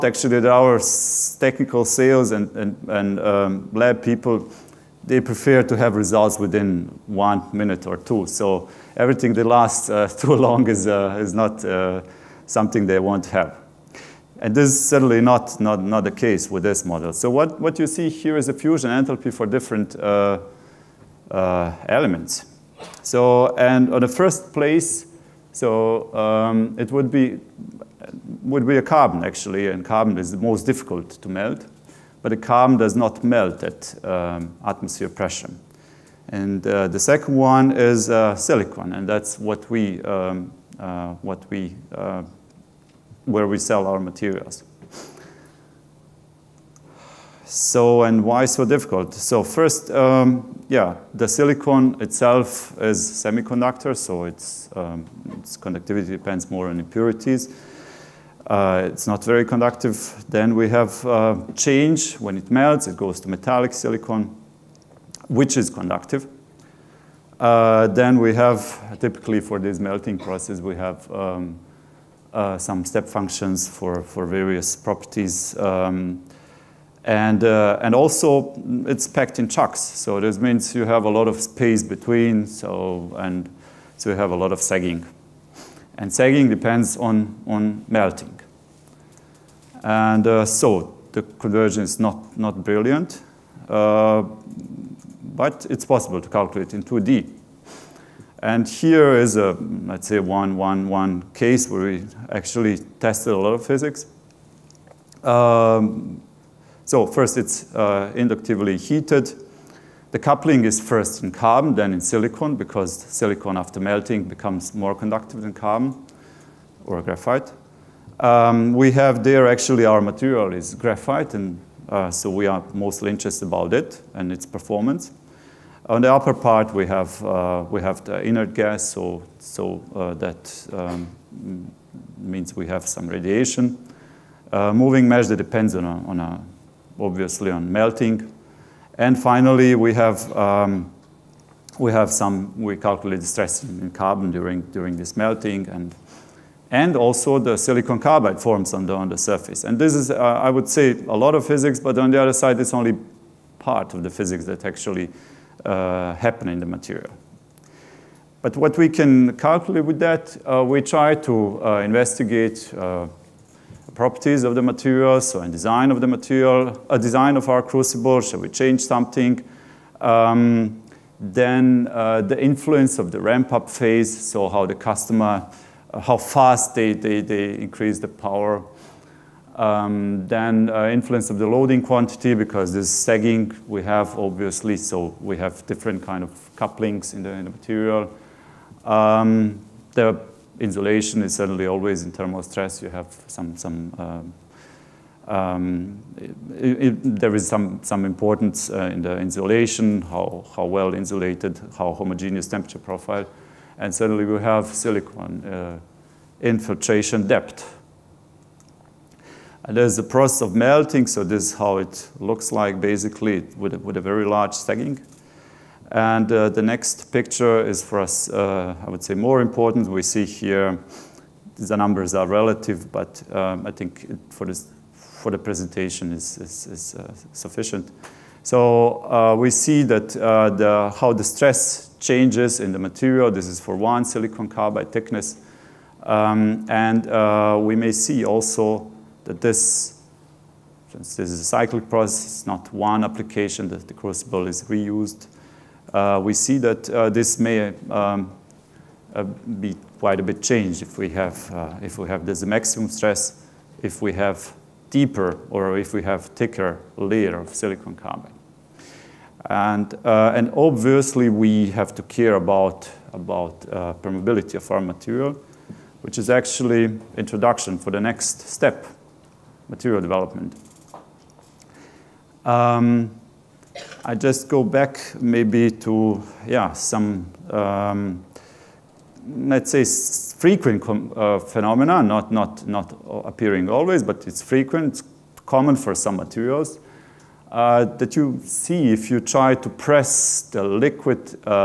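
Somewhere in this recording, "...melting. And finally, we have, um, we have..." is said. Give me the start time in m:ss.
2:17.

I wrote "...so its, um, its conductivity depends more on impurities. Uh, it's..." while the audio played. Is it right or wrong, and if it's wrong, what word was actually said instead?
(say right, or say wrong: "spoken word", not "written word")
right.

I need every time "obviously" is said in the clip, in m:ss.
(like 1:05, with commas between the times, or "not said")
2:16, 3:04, 4:20.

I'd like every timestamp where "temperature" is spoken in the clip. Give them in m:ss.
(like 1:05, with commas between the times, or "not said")
3:22.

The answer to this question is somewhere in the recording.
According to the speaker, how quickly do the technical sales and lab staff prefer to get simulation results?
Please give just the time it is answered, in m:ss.
0:06.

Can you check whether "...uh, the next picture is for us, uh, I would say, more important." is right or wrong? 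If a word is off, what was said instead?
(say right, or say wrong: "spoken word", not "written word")
right.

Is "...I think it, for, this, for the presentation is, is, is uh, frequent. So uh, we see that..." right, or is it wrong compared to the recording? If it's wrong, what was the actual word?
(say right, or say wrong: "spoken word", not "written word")
wrong: "sufficient", not "frequent".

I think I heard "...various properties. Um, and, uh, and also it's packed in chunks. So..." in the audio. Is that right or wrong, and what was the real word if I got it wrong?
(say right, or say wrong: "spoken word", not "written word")
right.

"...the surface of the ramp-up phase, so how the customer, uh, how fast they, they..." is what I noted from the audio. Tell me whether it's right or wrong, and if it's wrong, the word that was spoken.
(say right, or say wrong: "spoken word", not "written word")
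wrong: "influence", not "surface".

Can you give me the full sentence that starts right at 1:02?
When it melts, it goes to metallic silicon, which is conductive.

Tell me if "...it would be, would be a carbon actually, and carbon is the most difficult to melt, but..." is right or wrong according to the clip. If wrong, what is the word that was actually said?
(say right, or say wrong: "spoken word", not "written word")
right.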